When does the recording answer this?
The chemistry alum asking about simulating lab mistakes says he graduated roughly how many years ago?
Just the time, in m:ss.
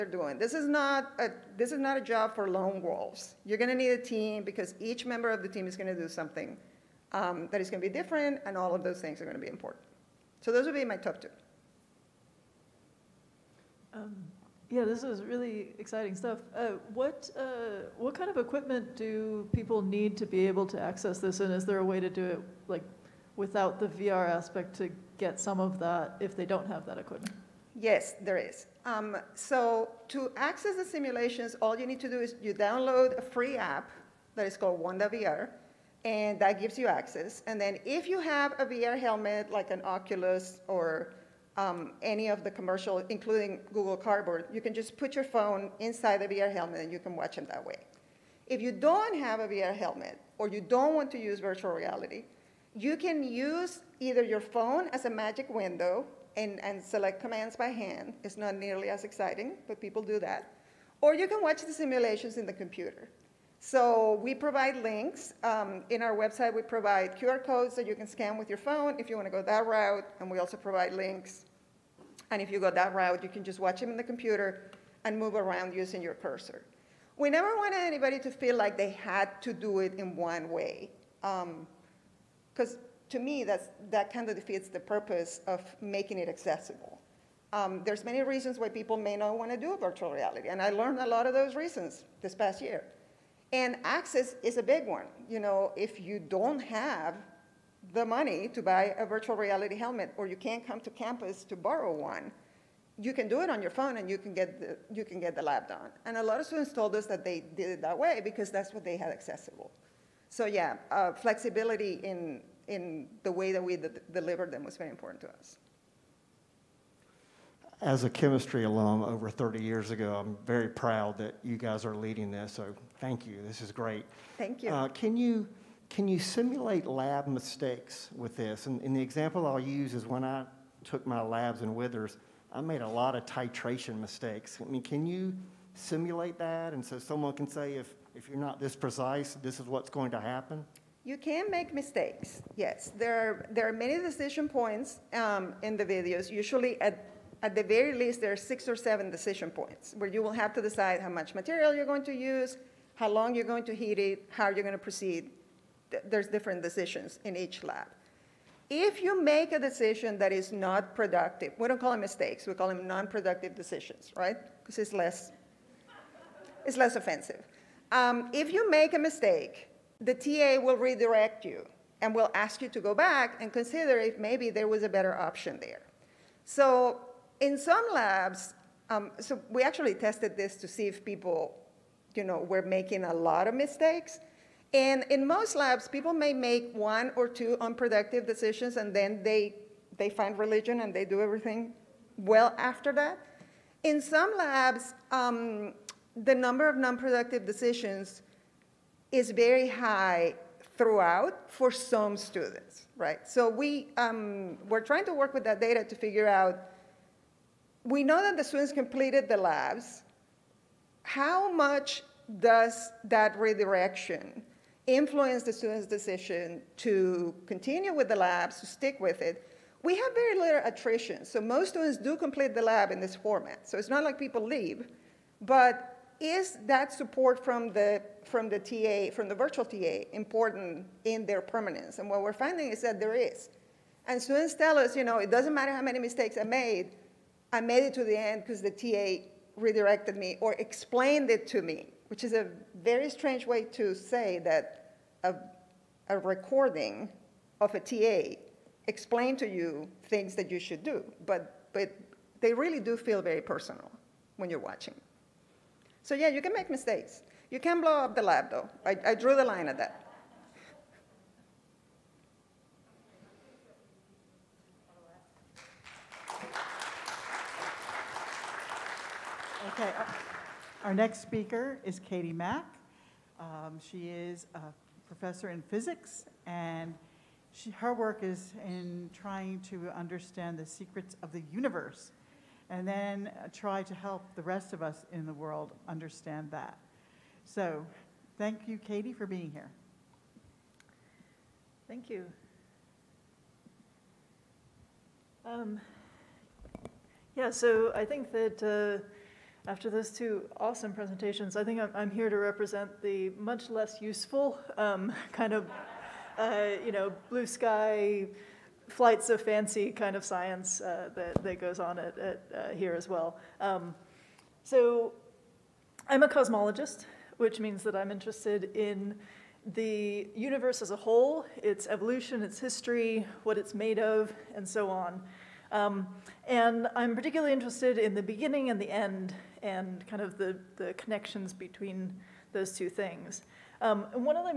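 1:59.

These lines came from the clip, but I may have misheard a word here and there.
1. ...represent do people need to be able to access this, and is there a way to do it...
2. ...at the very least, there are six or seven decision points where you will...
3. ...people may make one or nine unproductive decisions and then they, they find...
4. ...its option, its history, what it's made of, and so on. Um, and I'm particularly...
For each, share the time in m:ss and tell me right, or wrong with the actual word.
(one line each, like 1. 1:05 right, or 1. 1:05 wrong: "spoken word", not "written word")
1. 0:18 wrong: "equipment", not "represent"
2. 2:27 right
3. 3:05 wrong: "two", not "nine"
4. 5:21 wrong: "evolution", not "option".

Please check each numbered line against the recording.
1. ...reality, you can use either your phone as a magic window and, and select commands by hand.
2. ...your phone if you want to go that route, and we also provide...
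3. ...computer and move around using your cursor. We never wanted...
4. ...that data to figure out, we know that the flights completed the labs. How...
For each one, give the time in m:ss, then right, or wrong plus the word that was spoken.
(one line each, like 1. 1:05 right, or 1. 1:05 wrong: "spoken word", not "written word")
1. 0:51 right
2. 1:08 right
3. 1:14 right
4. 3:25 wrong: "students", not "flights".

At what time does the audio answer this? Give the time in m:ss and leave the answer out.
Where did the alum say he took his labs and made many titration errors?
2:11.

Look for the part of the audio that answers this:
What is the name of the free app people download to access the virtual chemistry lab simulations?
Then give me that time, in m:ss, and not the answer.
0:34.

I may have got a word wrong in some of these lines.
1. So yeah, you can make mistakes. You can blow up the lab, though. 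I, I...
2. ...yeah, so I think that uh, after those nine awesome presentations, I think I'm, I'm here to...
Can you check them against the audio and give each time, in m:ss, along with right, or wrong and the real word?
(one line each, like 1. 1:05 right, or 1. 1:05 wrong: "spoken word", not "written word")
1. 4:16 right
2. 4:57 wrong: "two", not "nine".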